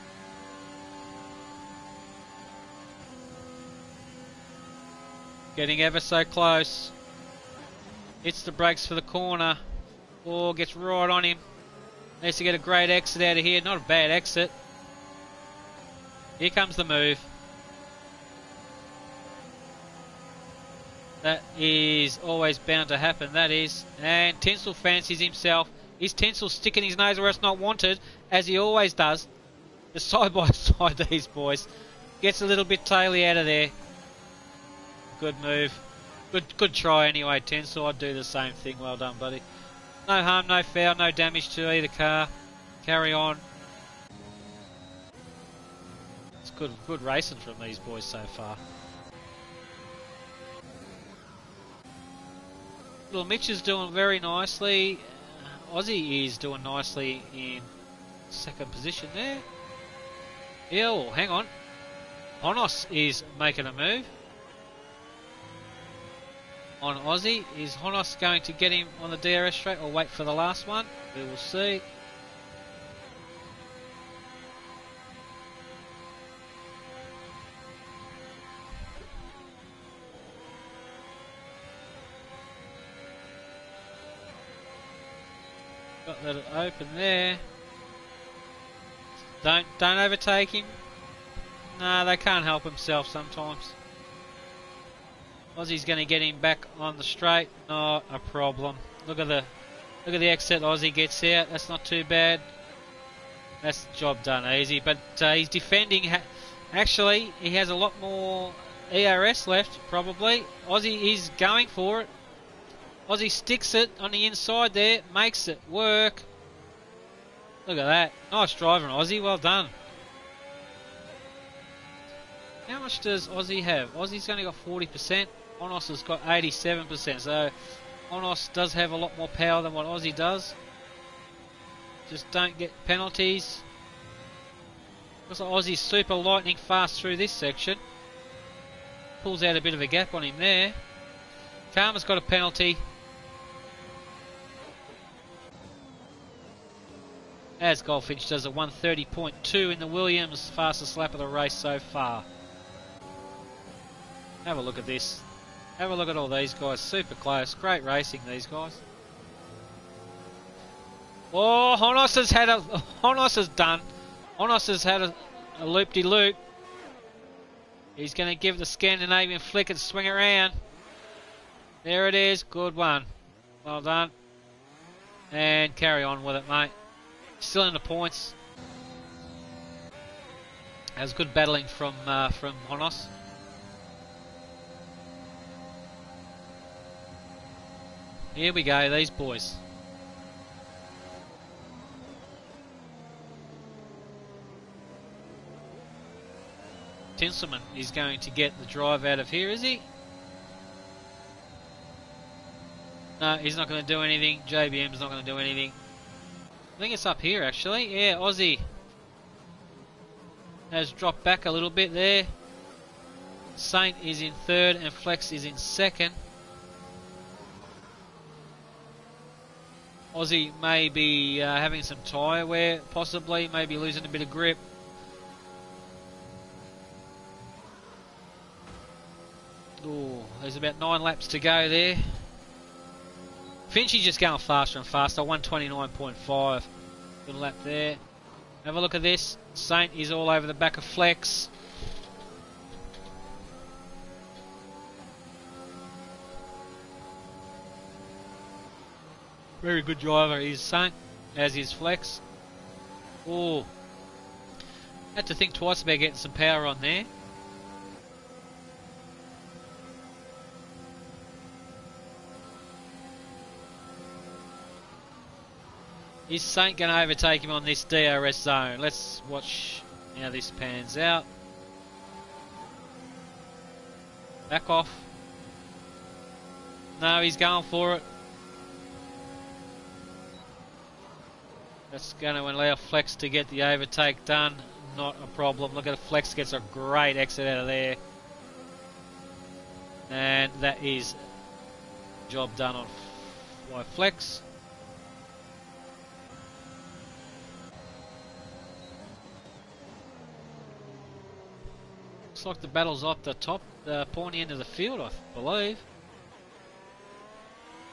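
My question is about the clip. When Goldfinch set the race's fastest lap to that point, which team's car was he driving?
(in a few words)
Williams.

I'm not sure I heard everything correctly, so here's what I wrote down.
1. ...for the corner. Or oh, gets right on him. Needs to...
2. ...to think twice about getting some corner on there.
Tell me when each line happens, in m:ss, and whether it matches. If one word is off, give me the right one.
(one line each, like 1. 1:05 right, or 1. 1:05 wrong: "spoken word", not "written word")
1. 0:08 right
2. 4:15 wrong: "power", not "corner".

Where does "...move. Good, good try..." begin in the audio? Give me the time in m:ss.
0:35.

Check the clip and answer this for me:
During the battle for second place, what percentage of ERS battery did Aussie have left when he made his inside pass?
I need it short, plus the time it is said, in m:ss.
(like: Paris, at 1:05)
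40%, at 2:04.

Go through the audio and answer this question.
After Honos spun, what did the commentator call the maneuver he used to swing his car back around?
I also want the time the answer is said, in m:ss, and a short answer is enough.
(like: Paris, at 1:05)
Scandinavian flick, at 2:48.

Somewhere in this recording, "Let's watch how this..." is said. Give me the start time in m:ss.
4:28.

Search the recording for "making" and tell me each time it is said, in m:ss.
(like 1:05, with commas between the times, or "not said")
1:03.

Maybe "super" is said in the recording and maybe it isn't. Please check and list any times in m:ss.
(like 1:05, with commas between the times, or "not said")
2:15, 2:36.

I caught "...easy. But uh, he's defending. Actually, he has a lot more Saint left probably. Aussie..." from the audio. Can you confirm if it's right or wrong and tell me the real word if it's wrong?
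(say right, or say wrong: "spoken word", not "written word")
wrong: "ERS", not "Saint".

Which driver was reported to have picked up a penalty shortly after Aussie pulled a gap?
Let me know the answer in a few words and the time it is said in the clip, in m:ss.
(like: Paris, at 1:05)
Karma, at 2:21.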